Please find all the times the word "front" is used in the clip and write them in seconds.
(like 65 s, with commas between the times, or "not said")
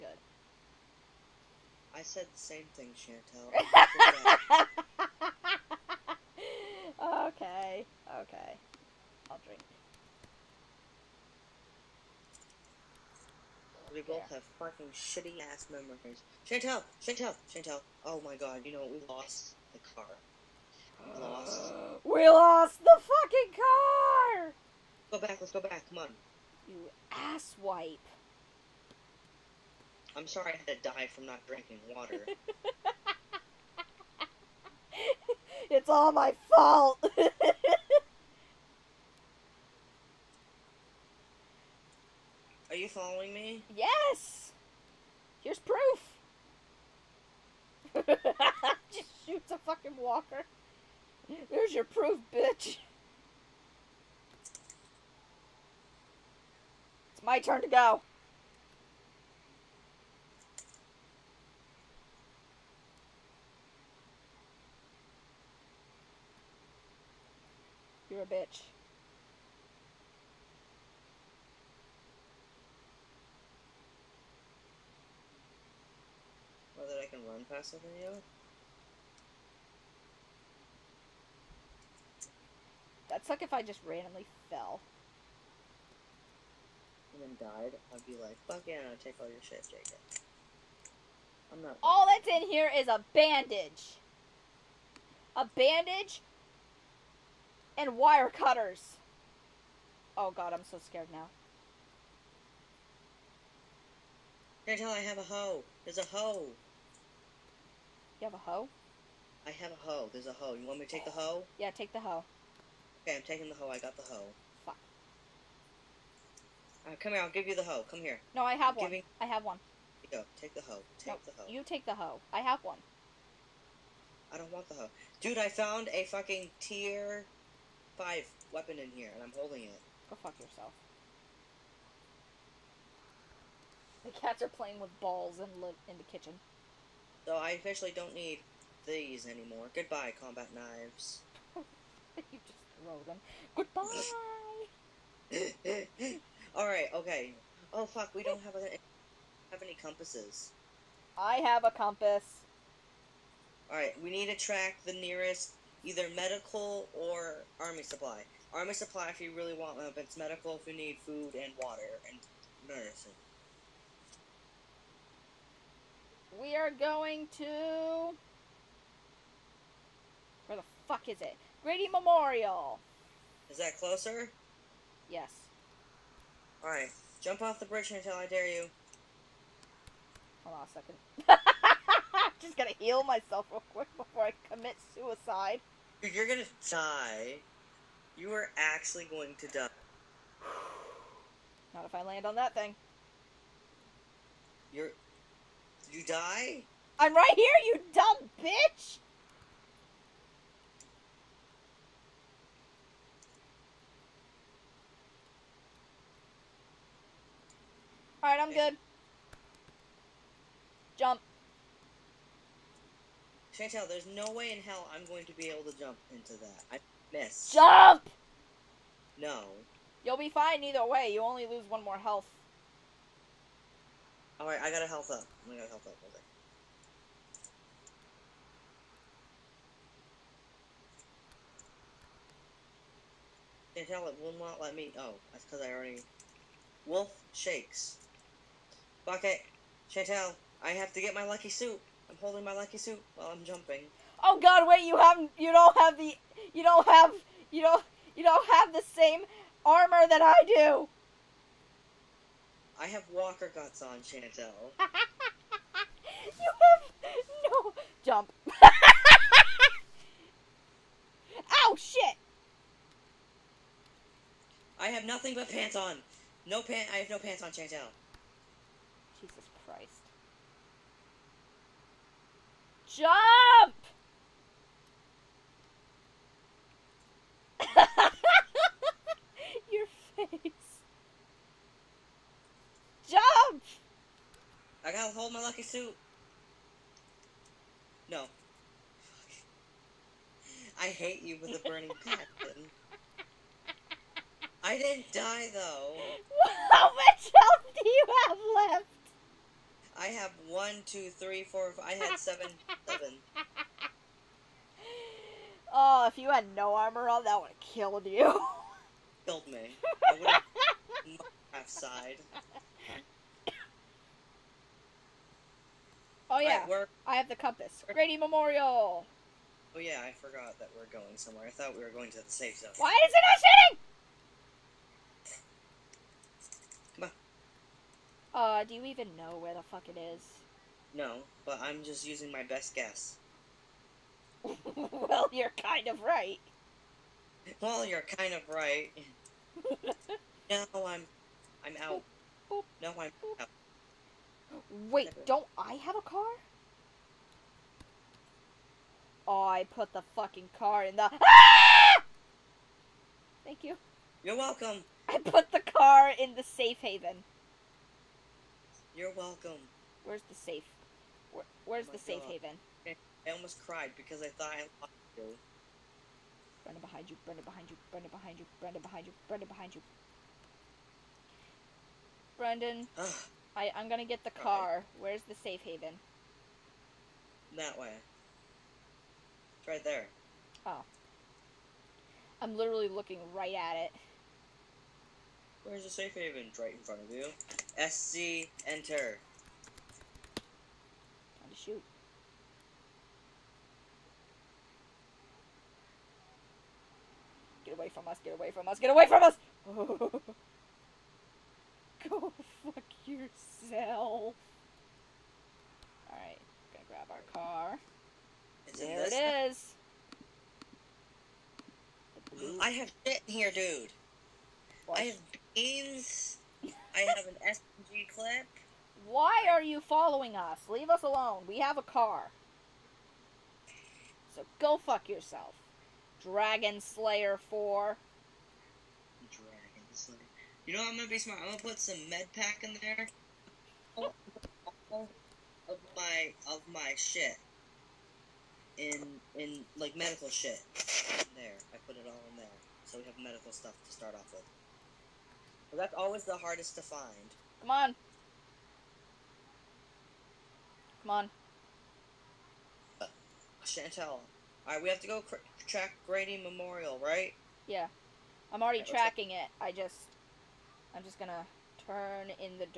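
386 s.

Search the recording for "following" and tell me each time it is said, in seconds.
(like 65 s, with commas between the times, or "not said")
42 s, 419 s.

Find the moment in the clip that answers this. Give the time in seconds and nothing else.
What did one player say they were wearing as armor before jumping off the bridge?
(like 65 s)
253 s.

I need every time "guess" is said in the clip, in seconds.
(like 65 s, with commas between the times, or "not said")
332 s.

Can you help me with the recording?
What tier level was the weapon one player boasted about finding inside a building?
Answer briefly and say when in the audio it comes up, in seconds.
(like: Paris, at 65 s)
Tier five, at 126 s.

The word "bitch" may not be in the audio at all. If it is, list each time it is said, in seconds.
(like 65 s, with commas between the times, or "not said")
52 s, 68 s, 198 s.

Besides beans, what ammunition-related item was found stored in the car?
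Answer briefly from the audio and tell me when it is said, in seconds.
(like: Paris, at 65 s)
SMG clip, at 417 s.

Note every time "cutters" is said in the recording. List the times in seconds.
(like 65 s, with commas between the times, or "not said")
98 s.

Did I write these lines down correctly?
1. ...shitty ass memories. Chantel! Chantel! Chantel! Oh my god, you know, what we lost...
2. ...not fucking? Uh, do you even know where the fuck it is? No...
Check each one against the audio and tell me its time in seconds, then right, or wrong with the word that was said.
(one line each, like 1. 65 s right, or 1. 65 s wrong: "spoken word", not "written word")
1. 14 s right
2. 323 s wrong: "shooting", not "fucking".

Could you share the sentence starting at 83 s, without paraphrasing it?
That's suck if I just randomly fell and then died, I'd be like, fuck yeah, I'll take all your shit, Jacob.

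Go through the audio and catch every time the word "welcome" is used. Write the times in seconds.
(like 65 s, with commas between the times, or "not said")
354 s, 359 s.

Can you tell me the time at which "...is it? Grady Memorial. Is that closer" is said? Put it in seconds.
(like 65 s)
171 s.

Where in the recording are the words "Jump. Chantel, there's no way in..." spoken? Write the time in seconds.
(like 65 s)
210 s.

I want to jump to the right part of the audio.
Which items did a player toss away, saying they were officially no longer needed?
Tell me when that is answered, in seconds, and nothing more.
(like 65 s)
140 s.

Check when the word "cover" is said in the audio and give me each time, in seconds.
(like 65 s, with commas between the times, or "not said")
not said.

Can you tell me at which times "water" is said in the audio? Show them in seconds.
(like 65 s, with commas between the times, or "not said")
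31 s, 161 s.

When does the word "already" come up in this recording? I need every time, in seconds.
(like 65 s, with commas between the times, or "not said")
235 s, 458 s.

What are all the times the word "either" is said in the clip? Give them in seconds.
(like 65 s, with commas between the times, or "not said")
155 s, 220 s.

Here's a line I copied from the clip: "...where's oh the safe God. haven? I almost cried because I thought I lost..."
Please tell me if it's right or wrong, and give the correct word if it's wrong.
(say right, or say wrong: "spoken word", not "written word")
right.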